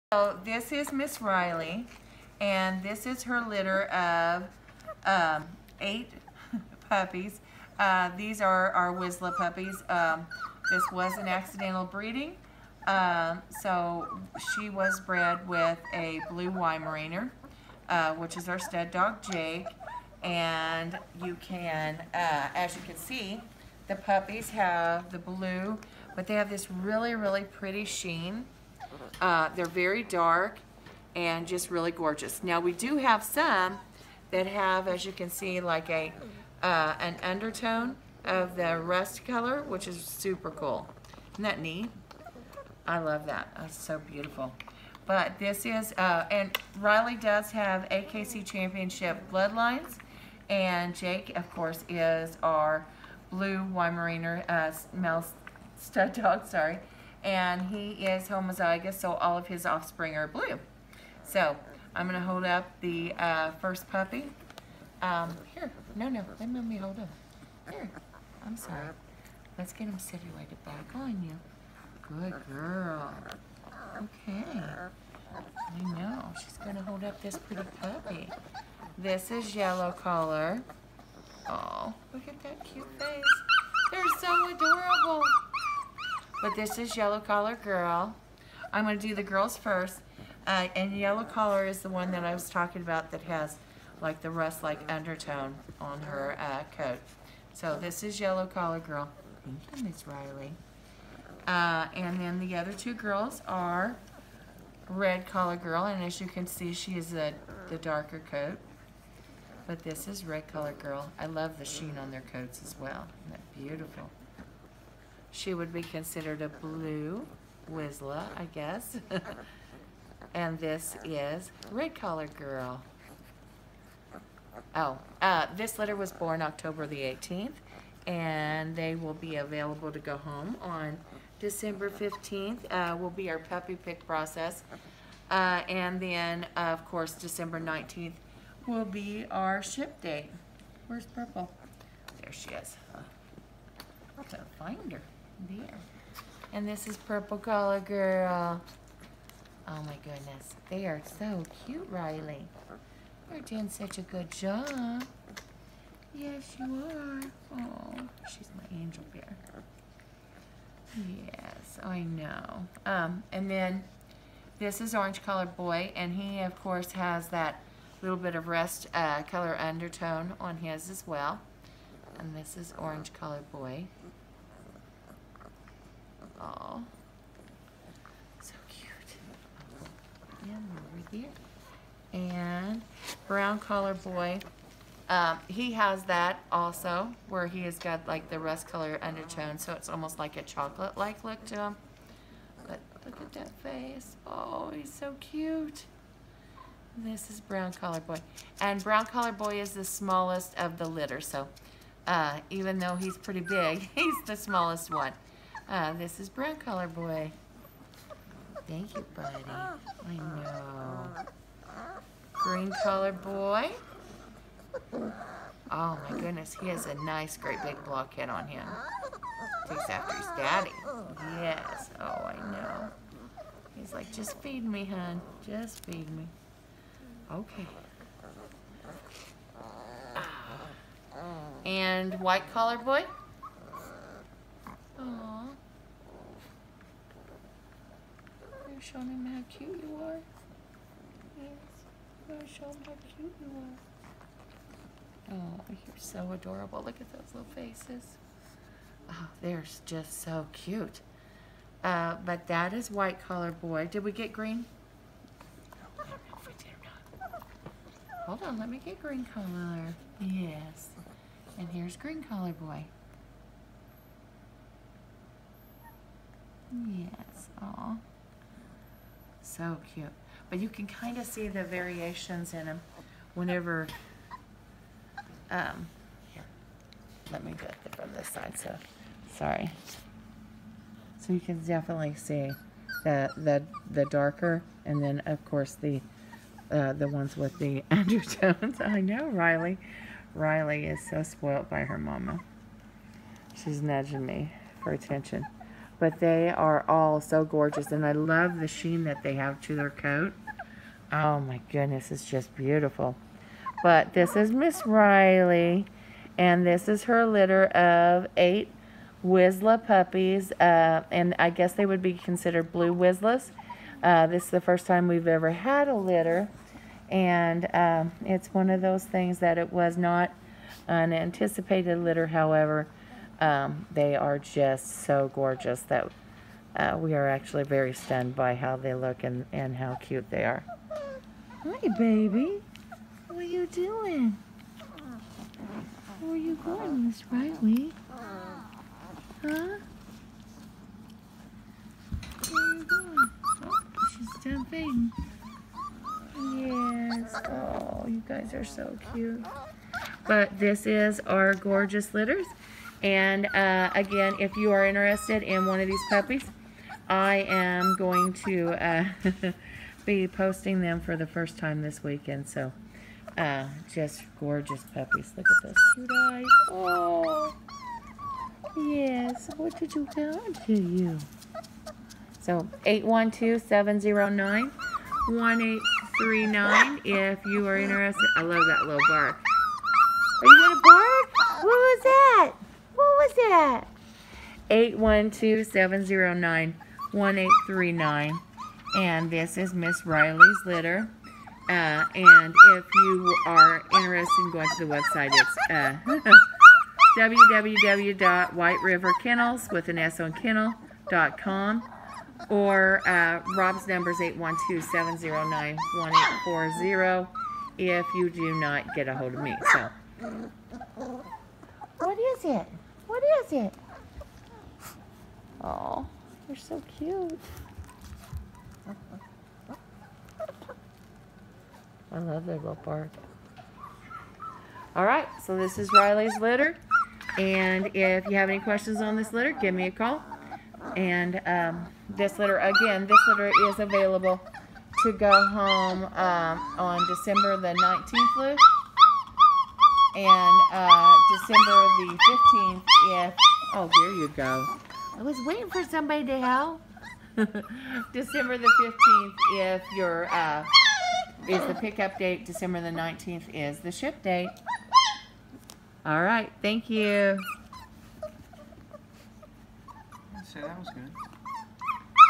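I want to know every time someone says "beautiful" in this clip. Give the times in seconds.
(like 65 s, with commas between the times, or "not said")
43 s, 113 s, 302 s.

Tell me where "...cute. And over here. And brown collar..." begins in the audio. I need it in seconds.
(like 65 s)
178 s.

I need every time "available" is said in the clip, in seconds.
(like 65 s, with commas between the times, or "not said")
129 s, 433 s.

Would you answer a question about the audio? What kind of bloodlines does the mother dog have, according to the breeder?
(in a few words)
AKC Championship Bloodlines.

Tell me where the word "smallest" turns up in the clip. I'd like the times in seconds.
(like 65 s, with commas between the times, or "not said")
199 s, 204 s.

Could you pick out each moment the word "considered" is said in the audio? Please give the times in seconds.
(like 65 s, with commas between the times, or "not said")
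115 s, 312 s.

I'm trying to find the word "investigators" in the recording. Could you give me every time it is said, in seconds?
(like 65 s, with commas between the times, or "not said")
not said.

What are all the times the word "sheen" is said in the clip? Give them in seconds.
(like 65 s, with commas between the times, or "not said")
27 s, 111 s, 298 s.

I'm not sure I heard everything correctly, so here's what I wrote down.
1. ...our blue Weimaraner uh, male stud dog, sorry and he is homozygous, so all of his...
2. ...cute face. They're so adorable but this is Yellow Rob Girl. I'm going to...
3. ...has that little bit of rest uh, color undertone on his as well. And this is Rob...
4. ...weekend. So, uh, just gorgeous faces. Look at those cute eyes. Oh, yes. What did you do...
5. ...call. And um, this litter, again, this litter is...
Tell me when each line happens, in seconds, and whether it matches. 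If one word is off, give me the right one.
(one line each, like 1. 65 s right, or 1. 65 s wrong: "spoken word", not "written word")
1. 52 s right
2. 82 s wrong: "Collar", not "Rob"
3. 166 s wrong: "Orange", not "Rob"
4. 362 s wrong: "puppies", not "faces"
5. 429 s right.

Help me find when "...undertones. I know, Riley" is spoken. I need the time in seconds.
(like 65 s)
287 s.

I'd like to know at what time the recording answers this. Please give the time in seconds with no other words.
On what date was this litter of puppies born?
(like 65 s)
126 s.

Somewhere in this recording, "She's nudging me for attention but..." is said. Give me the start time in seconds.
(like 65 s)
293 s.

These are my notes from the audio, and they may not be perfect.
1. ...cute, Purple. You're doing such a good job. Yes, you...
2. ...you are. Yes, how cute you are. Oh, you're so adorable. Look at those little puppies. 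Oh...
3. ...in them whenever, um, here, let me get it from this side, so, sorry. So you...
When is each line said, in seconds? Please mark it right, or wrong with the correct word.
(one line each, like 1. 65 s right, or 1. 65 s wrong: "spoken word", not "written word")
1. 151 s wrong: "Riley", not "Purple"
2. 239 s wrong: "faces", not "puppies"
3. 272 s right.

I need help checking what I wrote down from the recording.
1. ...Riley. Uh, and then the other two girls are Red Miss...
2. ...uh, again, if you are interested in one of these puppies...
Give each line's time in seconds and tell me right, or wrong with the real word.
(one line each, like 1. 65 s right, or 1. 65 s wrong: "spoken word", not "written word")
1. 100 s wrong: "Collar", not "Miss"
2. 353 s right.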